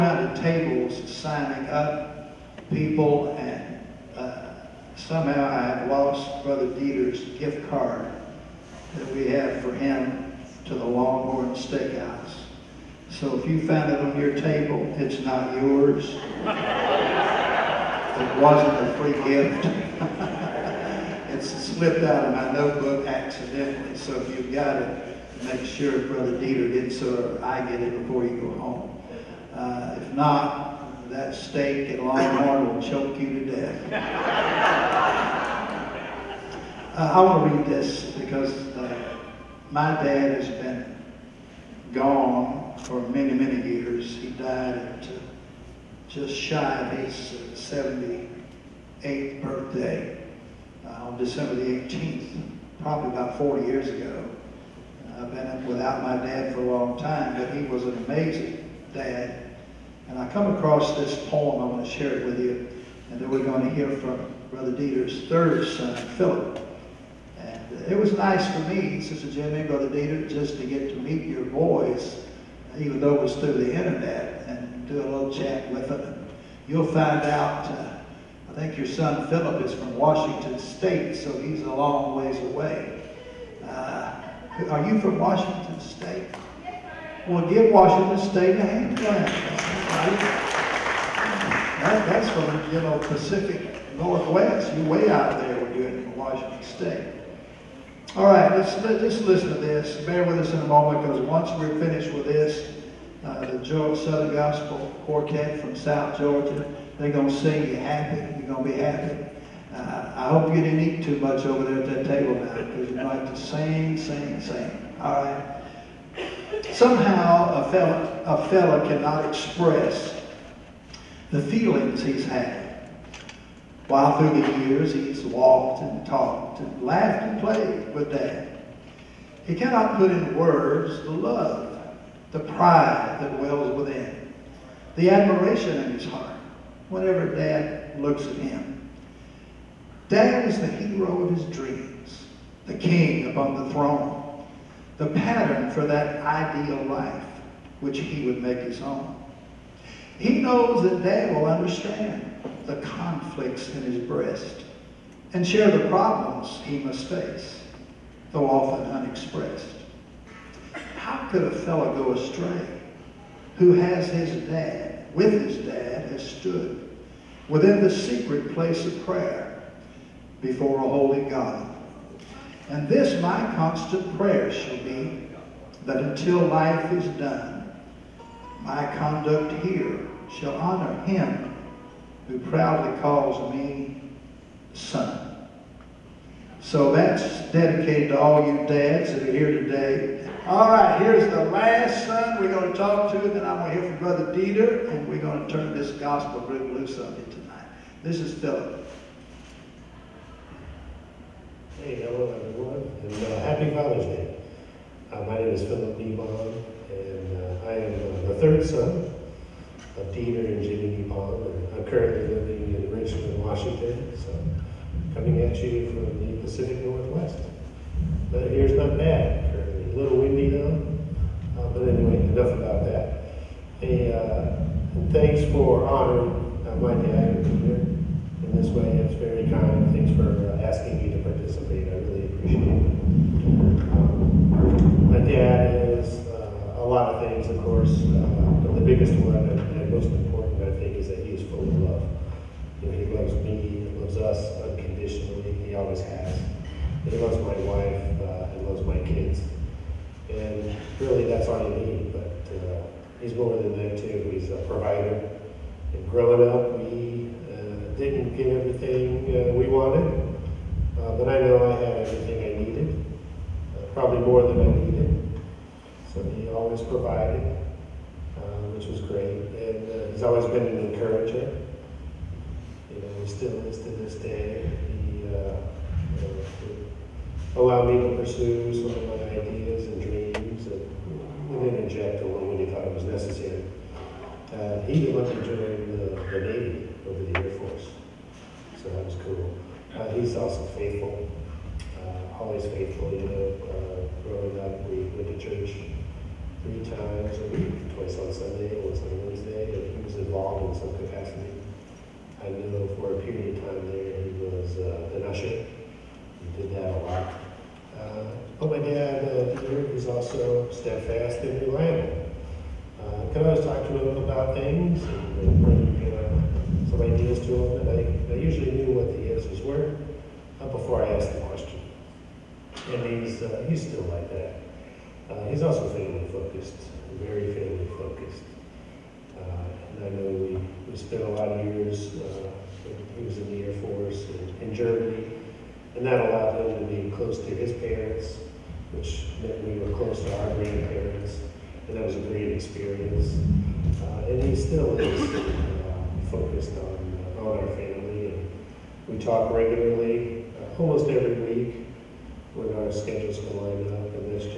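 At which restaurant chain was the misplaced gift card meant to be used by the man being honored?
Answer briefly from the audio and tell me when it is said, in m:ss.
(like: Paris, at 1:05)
Longhorn Steakhouse, at 0:10.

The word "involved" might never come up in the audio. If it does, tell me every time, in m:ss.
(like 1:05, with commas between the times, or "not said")
5:00.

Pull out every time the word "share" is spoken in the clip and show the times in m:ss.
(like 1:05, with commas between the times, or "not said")
1:01, 2:35.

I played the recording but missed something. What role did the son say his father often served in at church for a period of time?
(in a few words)
usher.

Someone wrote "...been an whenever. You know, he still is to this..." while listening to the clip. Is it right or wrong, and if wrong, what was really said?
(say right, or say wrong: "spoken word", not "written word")
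wrong: "encourager", not "whenever".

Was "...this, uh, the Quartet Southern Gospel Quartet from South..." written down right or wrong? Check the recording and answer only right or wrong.
wrong.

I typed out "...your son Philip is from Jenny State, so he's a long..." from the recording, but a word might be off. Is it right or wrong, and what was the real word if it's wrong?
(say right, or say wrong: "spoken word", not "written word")
wrong: "Washington", not "Jenny".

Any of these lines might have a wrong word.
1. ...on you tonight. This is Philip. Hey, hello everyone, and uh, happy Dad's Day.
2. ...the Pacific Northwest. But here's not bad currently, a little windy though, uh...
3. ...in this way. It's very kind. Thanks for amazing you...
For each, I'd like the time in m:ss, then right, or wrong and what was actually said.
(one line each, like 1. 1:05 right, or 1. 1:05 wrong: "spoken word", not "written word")
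1. 3:16 wrong: "Father", not "Dad"
2. 3:36 right
3. 3:47 wrong: "asking", not "amazing".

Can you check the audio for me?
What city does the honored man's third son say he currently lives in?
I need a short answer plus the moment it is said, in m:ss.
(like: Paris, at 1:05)
Richmond, at 3:32.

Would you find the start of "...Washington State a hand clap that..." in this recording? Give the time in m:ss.
1:27.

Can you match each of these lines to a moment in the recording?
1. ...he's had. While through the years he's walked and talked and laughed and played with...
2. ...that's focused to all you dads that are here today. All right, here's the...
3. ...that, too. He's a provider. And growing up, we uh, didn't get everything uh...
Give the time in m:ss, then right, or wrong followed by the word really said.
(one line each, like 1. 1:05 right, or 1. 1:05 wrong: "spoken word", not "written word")
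1. 2:02 right
2. 3:06 wrong: "dedicated", not "focused"
3. 4:13 right.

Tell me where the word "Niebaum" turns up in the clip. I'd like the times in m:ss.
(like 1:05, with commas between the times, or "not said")
3:25, 3:30.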